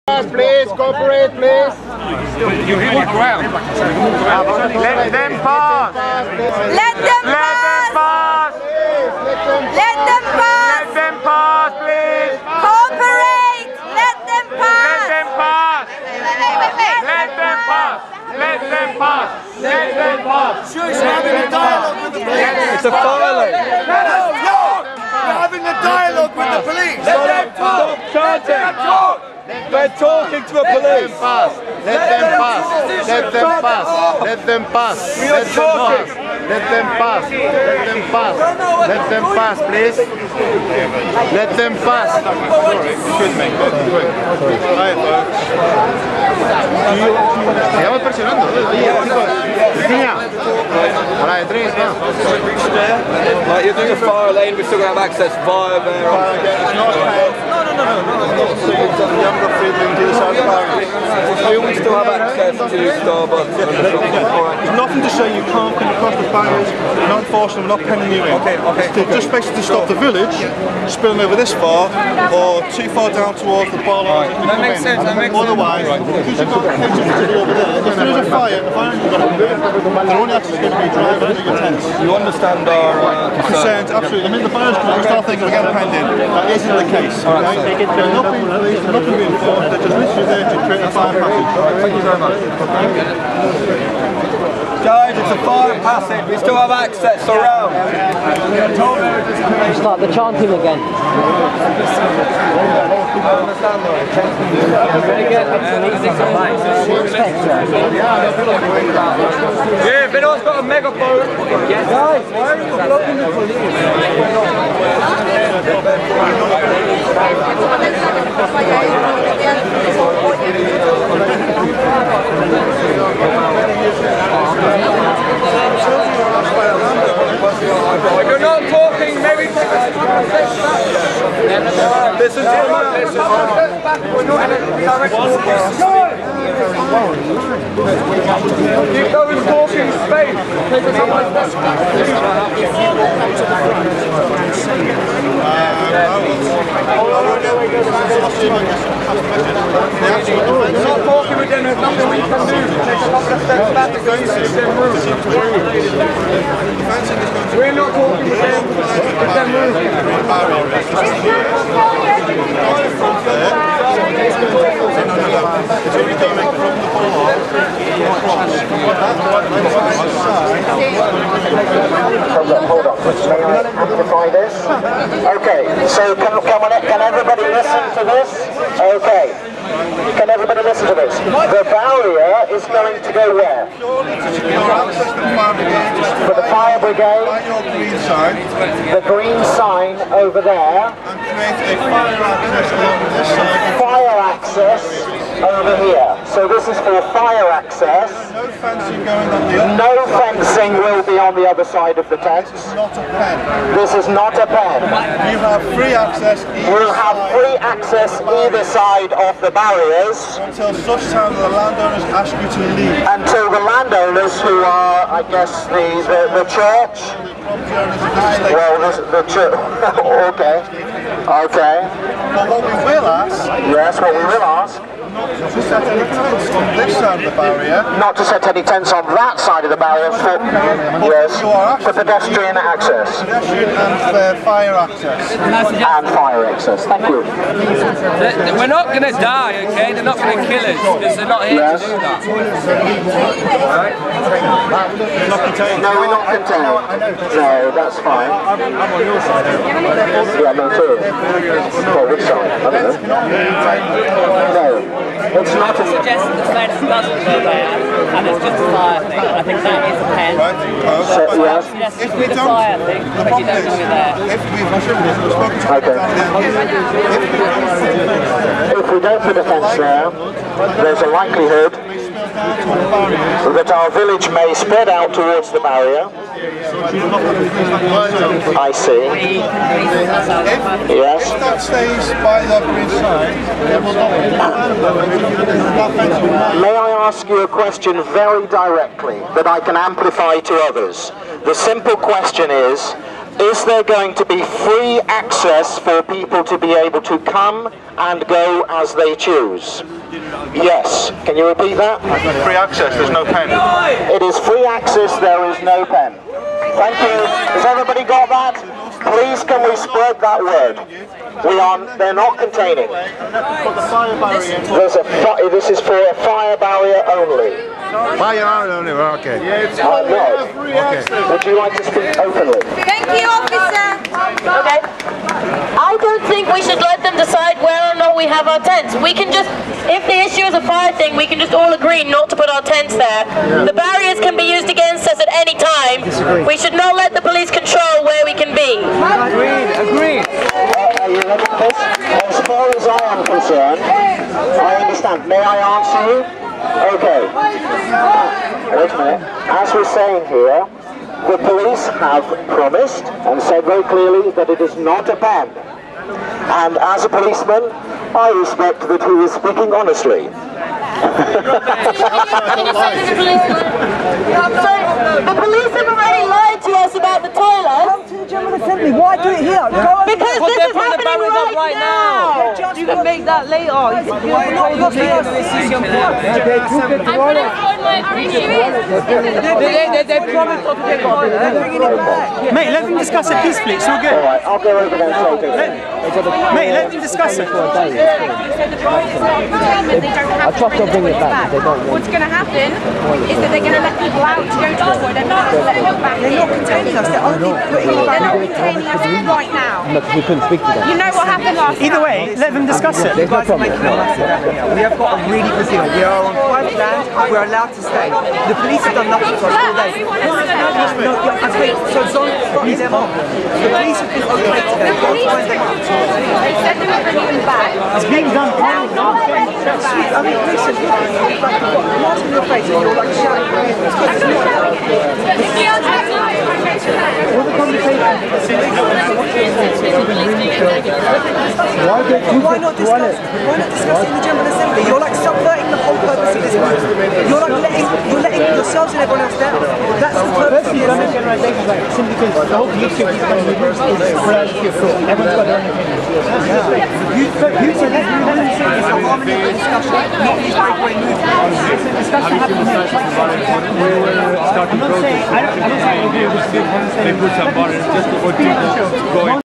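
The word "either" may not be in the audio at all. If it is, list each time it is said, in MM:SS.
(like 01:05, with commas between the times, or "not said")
03:28, 06:41.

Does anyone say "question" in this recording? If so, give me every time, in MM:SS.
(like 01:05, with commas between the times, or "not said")
04:47, 04:51.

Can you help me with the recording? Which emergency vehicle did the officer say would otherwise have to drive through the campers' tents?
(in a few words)
fire engine.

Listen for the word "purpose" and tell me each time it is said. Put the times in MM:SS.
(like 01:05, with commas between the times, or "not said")
07:16, 07:20.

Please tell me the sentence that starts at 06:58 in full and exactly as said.
I mean, listen, look, you're like shouting.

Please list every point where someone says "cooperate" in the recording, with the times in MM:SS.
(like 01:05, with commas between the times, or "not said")
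00:00, 00:12.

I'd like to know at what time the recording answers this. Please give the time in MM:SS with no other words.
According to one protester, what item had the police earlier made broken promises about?
06:07.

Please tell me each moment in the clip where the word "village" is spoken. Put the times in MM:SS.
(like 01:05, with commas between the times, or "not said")
01:09, 04:33.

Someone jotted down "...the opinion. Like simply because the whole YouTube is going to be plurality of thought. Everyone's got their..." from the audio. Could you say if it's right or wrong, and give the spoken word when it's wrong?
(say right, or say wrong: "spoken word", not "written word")
wrong: "generalization", not "opinion".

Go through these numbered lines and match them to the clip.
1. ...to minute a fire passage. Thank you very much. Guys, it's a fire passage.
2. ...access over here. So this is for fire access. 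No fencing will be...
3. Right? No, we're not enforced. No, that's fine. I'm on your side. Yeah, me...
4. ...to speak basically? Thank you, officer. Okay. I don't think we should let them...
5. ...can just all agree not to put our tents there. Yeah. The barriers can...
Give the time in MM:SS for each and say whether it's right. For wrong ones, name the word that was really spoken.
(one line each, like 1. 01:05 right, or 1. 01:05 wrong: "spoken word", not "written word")
1. 01:30 wrong: "create", not "minute"
2. 03:14 right
3. 04:03 wrong: "contained", not "enforced"
4. 05:21 wrong: "openly", not "basically"
5. 05:31 right.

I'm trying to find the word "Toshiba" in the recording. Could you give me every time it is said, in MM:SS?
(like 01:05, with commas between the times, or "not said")
not said.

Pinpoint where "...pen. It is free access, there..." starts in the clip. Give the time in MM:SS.
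05:03.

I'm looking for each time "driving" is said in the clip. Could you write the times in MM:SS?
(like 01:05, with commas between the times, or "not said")
01:20.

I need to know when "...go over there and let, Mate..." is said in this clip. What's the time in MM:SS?
06:24.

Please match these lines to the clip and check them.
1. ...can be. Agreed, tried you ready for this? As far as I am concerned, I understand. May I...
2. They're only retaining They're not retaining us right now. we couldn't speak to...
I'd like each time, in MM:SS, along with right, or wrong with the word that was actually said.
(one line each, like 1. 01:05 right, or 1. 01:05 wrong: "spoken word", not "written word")
1. 05:38 wrong: "agreed", not "tried"
2. 06:37 wrong: "putting", not "retaining".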